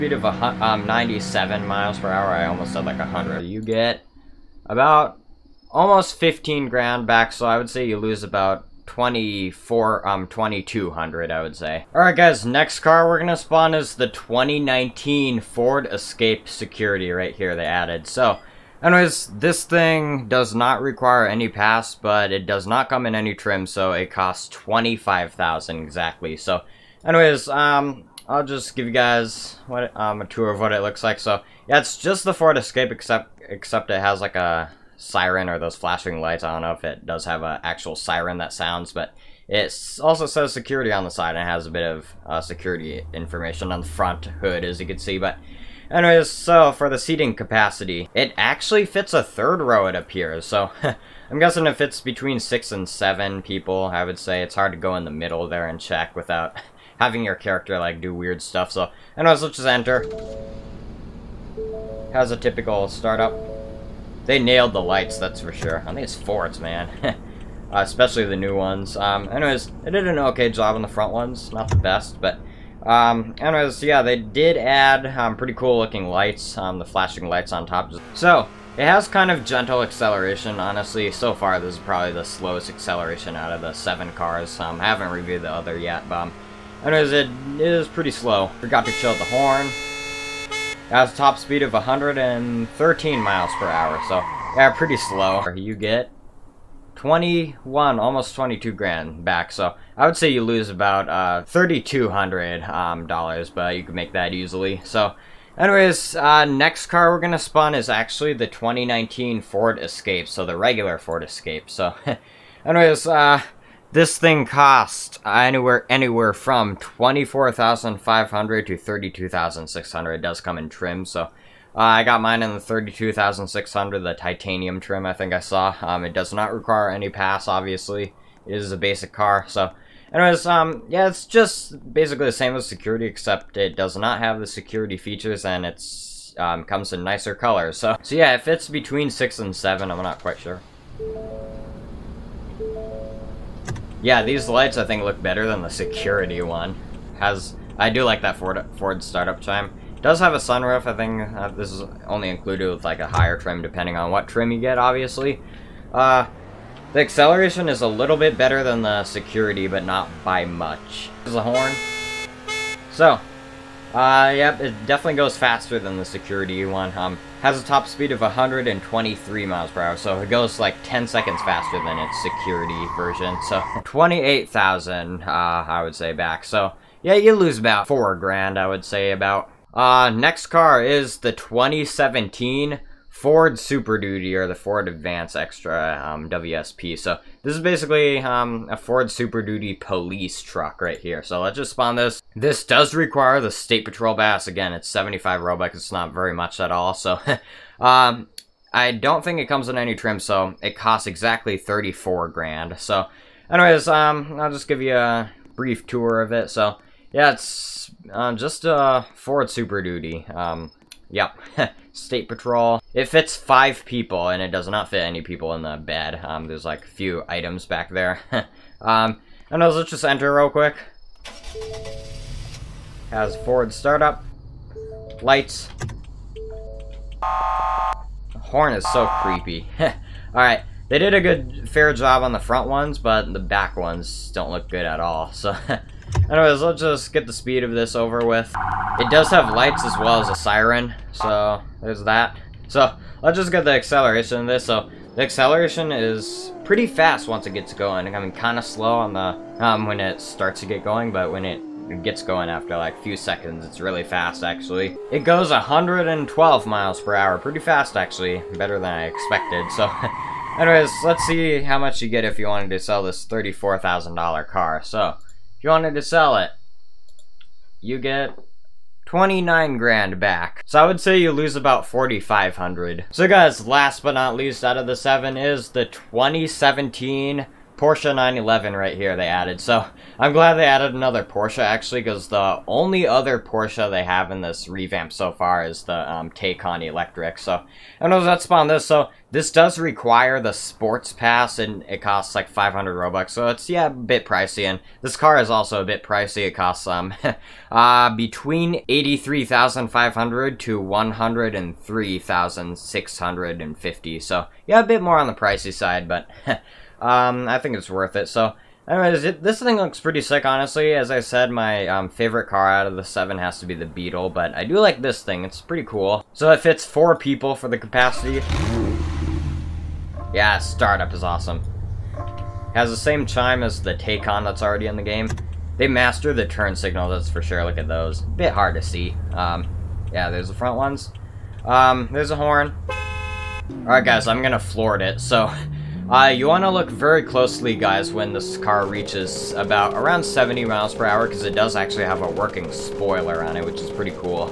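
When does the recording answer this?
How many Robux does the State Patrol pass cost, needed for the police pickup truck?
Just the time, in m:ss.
3:14.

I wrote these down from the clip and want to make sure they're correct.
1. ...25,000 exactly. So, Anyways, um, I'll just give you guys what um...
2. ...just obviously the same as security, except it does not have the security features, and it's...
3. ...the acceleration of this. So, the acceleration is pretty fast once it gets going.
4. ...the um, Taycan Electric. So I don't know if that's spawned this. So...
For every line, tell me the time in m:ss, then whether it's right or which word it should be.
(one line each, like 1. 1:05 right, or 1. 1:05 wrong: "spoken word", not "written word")
1. 0:24 right
2. 2:11 wrong: "basically", not "obviously"
3. 4:03 right
4. 4:45 right.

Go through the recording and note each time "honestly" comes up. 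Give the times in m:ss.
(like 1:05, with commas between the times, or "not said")
1:20, 5:10.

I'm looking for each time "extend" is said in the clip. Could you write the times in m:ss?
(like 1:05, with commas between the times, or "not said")
not said.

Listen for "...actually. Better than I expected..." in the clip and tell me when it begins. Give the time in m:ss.
4:17.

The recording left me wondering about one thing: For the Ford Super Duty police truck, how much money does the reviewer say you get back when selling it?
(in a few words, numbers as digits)
29 grand.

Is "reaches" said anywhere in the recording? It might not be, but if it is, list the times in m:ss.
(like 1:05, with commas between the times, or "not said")
5:38.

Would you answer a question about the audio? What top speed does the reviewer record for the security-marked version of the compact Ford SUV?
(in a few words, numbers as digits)
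113 mph.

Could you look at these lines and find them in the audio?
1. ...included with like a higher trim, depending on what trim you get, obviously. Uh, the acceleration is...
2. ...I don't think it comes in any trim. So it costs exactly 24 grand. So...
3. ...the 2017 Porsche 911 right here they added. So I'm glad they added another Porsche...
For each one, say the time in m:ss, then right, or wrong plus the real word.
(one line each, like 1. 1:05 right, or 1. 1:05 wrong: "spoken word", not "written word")
1. 2:32 right
2. 3:18 wrong: "34", not "24"
3. 4:35 right.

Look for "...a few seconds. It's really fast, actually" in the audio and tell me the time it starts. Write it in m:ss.
4:12.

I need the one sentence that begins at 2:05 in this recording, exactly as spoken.
Um, it does not require any pass, obviously.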